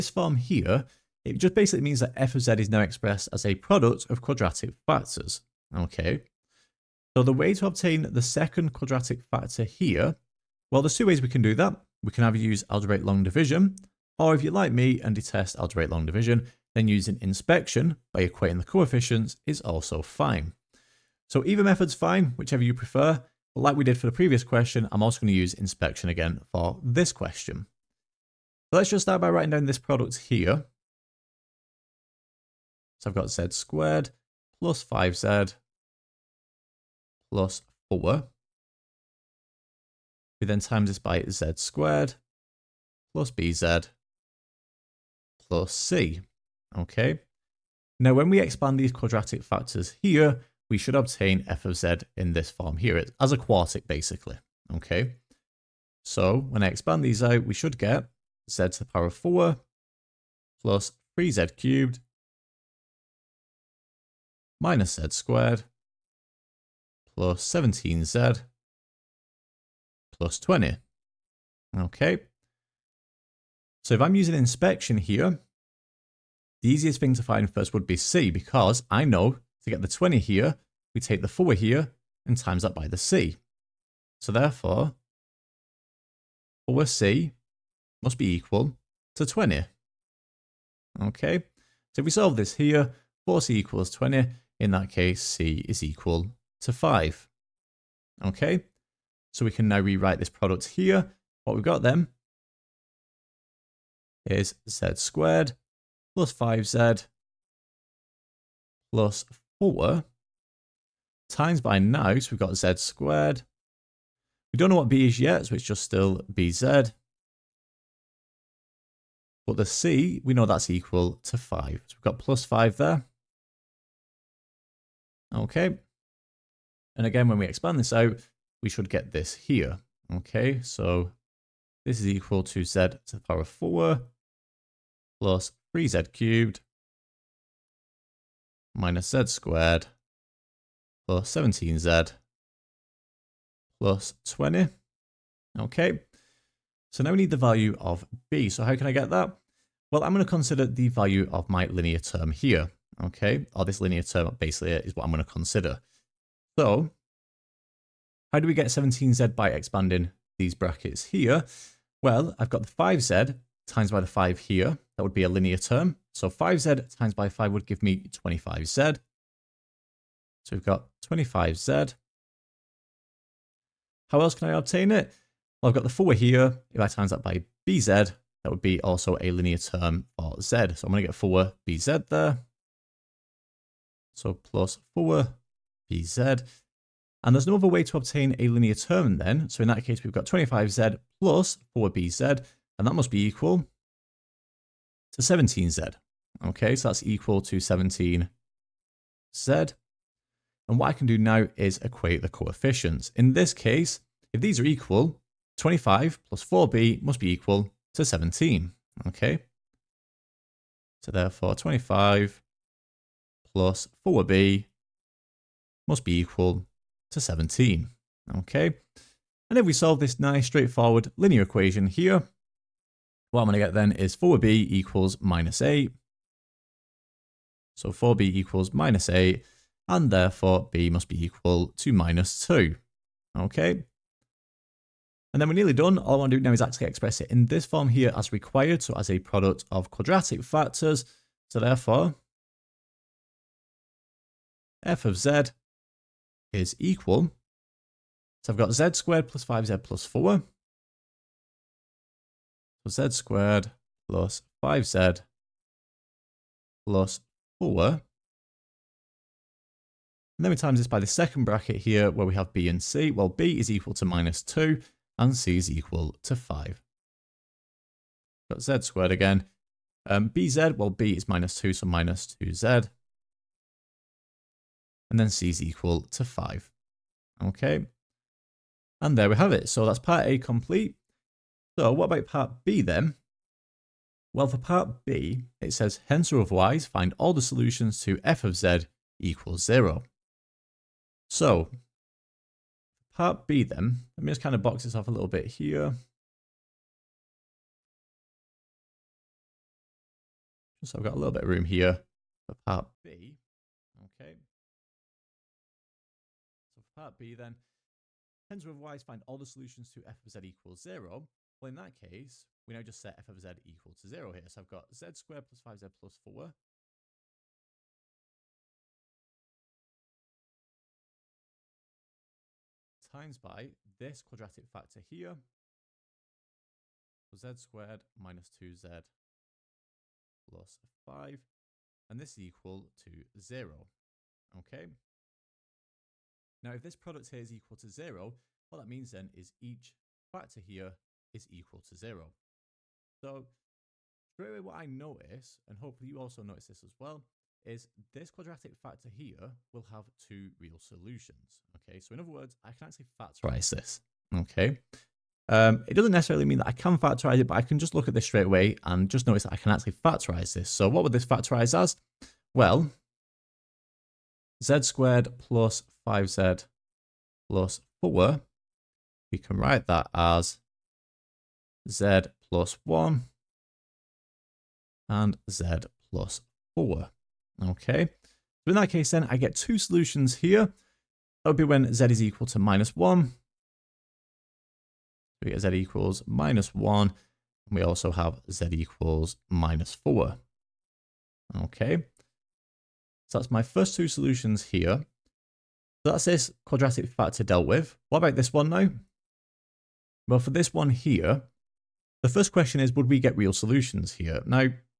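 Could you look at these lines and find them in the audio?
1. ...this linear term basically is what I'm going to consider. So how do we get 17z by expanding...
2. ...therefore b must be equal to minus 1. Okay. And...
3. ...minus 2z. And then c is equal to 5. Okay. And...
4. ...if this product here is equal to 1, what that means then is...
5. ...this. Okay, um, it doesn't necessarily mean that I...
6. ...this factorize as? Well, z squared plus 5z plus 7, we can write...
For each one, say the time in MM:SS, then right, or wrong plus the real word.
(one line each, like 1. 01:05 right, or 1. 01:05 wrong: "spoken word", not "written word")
1. 02:33 right
2. 03:50 wrong: "2", not "1"
3. 04:31 right
4. 05:36 wrong: "0", not "1"
5. 05:53 right
6. 06:01 wrong: "4", not "7".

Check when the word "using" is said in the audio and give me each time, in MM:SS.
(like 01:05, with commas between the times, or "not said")
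00:16, 01:14.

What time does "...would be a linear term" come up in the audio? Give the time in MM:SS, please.
02:45.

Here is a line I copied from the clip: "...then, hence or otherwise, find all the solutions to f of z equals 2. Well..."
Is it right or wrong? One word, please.
wrong.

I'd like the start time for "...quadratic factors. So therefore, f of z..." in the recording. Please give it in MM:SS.
03:59.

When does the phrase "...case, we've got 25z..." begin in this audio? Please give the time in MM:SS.
03:09.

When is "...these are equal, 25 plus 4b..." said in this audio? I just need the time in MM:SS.
03:24.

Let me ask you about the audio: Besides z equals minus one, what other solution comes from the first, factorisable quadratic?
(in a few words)
-4.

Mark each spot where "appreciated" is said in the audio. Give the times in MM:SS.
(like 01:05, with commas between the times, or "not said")
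not said.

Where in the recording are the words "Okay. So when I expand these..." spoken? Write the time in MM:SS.
00:54.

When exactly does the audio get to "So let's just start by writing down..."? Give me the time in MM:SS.
00:28.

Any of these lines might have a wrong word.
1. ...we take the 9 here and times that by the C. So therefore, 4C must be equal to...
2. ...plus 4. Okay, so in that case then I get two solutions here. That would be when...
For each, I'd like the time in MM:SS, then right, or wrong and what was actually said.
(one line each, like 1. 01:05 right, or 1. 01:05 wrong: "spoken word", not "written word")
1. 01:20 wrong: "4", not "9"
2. 06:16 right.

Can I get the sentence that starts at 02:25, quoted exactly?
Okay, so now we need the value of b.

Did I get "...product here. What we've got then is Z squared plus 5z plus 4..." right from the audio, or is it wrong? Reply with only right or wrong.
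right.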